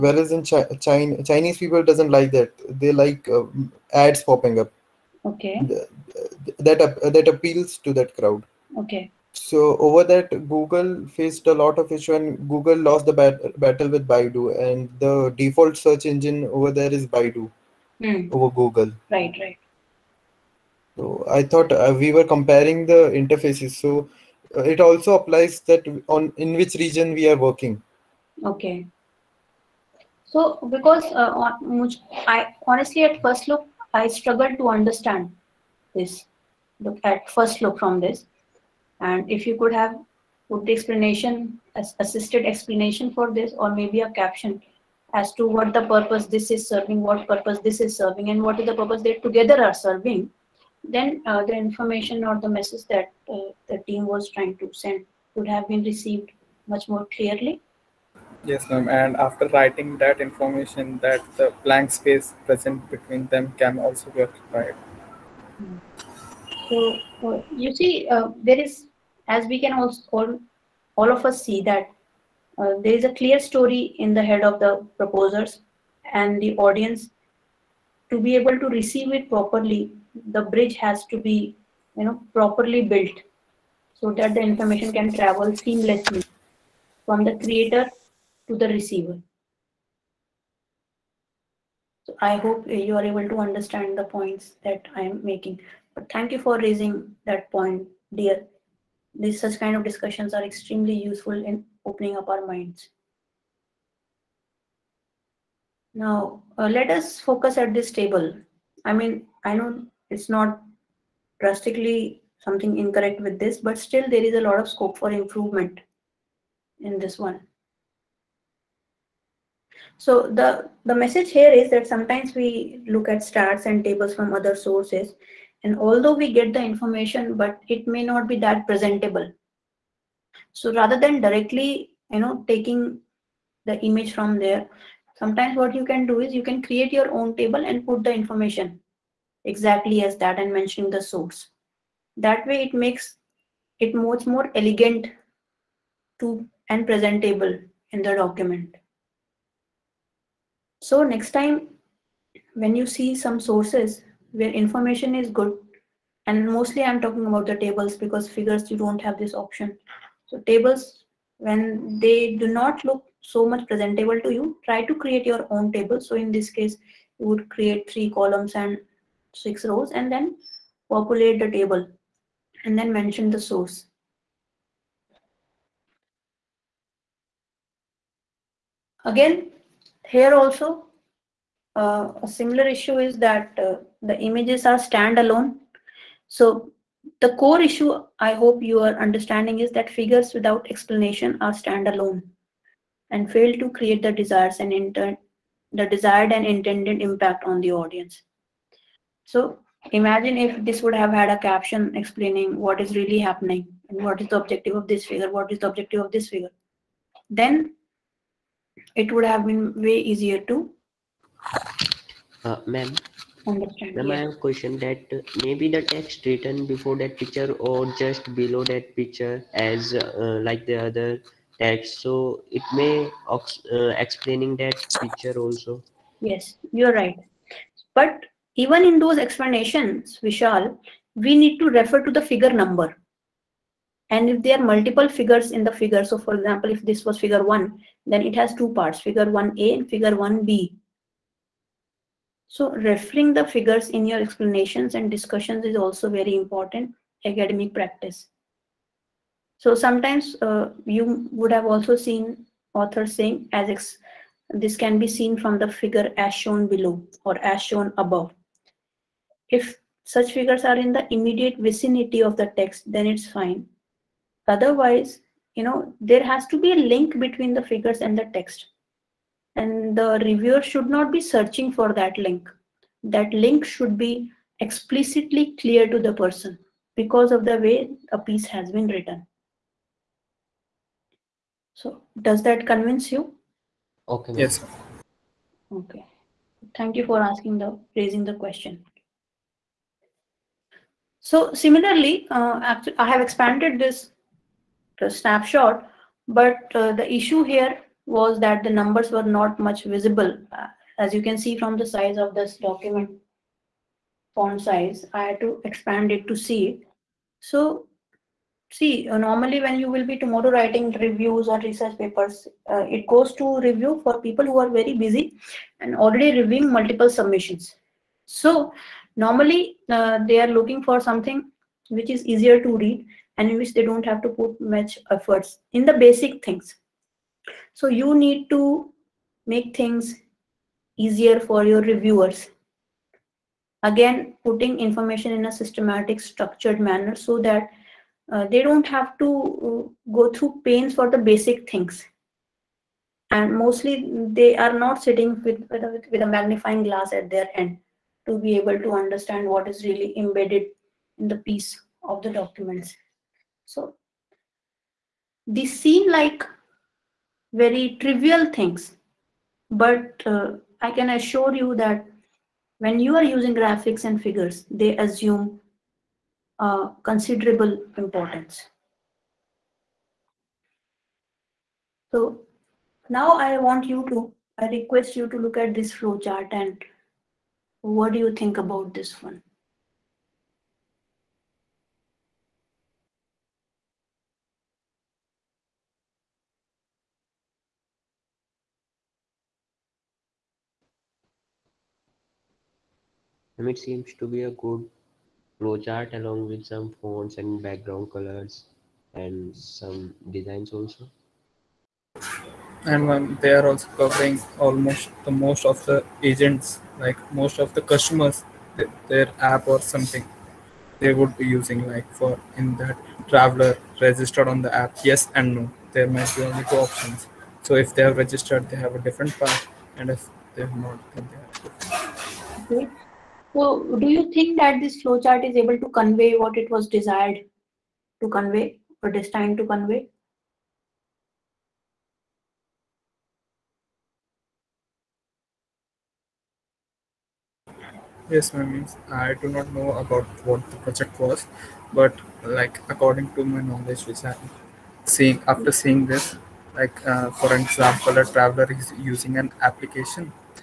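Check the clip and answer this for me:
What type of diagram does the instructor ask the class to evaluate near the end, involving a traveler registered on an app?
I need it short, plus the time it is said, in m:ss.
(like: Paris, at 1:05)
flow chart, at 6:15.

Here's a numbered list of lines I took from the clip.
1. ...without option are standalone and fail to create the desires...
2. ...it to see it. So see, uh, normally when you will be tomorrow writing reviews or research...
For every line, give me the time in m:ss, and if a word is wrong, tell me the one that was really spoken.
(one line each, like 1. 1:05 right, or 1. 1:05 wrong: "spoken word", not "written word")
1. 3:10 wrong: "explanation", not "option"
2. 5:06 right.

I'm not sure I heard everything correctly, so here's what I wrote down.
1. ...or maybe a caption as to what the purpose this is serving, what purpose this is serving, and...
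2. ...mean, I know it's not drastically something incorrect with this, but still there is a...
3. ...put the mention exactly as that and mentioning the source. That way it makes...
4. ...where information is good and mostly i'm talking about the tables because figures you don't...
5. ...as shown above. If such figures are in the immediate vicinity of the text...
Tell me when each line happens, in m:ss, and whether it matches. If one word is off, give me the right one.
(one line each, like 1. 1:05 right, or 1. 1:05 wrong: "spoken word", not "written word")
1. 0:43 right
2. 1:48 right
3. 2:17 wrong: "information", not "mention"
4. 2:34 right
5. 4:17 right.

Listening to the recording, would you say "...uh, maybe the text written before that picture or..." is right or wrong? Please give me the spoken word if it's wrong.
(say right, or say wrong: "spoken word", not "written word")
right.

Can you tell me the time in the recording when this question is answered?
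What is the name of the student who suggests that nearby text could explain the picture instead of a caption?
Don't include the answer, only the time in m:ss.
3:50.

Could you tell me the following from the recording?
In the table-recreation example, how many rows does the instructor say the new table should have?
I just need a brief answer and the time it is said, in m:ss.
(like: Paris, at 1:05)
6, at 2:49.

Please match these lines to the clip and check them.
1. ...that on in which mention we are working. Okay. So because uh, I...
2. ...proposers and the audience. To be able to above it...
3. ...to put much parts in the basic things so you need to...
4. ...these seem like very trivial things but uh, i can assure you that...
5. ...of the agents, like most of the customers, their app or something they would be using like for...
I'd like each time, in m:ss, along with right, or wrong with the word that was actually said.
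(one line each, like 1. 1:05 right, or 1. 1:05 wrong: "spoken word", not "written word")
1. 0:25 wrong: "region", not "mention"
2. 1:14 wrong: "receive", not "above"
3. 5:24 wrong: "efforts", not "parts"
4. 5:55 right
5. 6:45 right.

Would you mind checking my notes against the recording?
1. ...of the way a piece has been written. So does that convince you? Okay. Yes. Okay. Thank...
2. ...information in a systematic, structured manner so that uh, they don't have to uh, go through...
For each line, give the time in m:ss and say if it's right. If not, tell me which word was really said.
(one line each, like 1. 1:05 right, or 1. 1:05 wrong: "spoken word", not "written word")
1. 4:37 right
2. 5:34 right.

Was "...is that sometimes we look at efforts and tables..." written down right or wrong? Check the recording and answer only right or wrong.
wrong.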